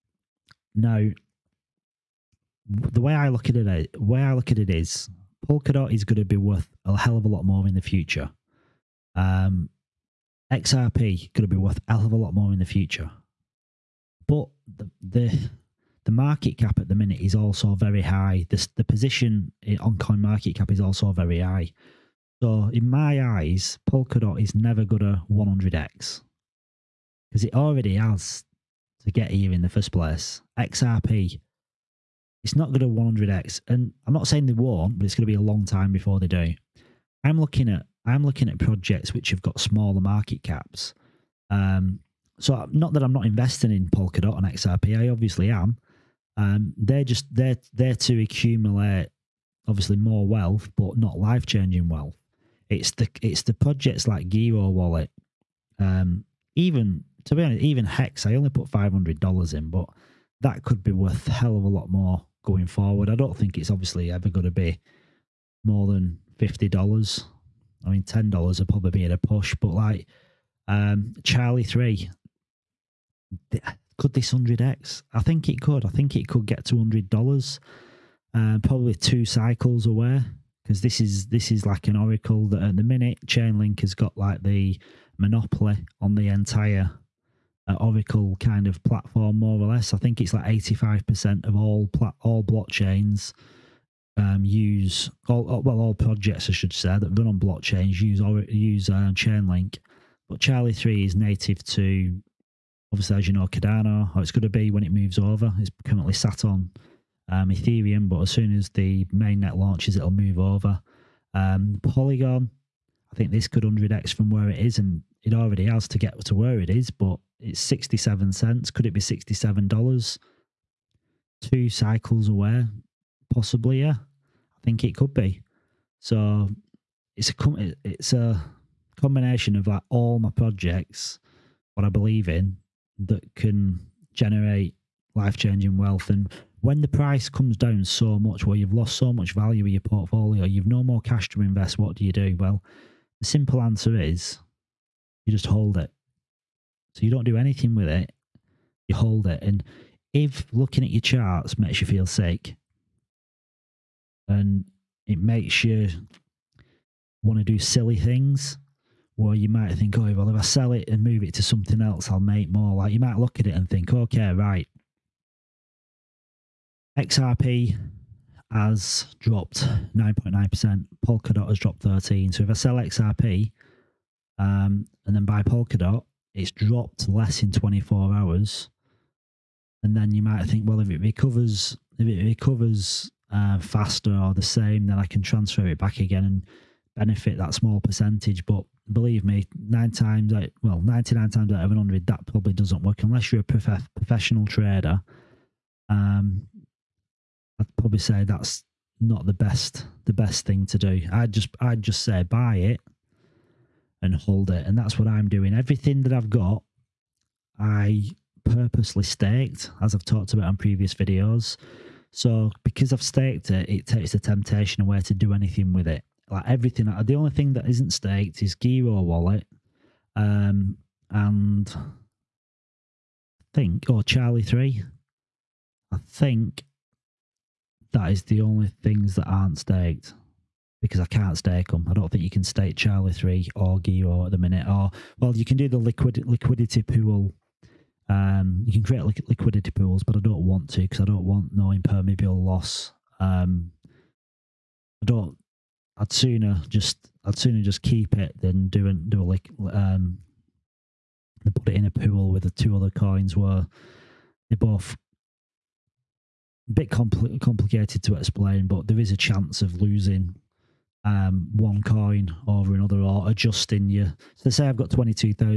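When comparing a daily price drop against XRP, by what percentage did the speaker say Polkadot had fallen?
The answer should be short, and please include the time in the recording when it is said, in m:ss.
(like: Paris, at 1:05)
13%, at 2:51.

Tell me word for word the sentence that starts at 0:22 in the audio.
So in my eyes, Polkadot is never going to 100x because it already has to get here in the first place.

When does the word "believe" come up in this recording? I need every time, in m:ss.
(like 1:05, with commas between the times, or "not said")
2:11, 3:08.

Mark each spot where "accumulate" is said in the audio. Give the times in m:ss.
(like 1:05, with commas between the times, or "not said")
0:48.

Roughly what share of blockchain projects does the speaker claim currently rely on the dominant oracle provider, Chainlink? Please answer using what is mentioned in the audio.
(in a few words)
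85%.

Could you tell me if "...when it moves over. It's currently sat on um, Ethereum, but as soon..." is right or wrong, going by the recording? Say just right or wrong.
right.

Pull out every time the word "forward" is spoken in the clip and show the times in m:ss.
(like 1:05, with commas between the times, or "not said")
1:02.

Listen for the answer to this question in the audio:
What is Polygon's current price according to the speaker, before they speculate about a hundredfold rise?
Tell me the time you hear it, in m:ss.
1:57.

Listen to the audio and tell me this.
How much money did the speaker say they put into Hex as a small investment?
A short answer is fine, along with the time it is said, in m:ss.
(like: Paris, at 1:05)
$500, at 0:58.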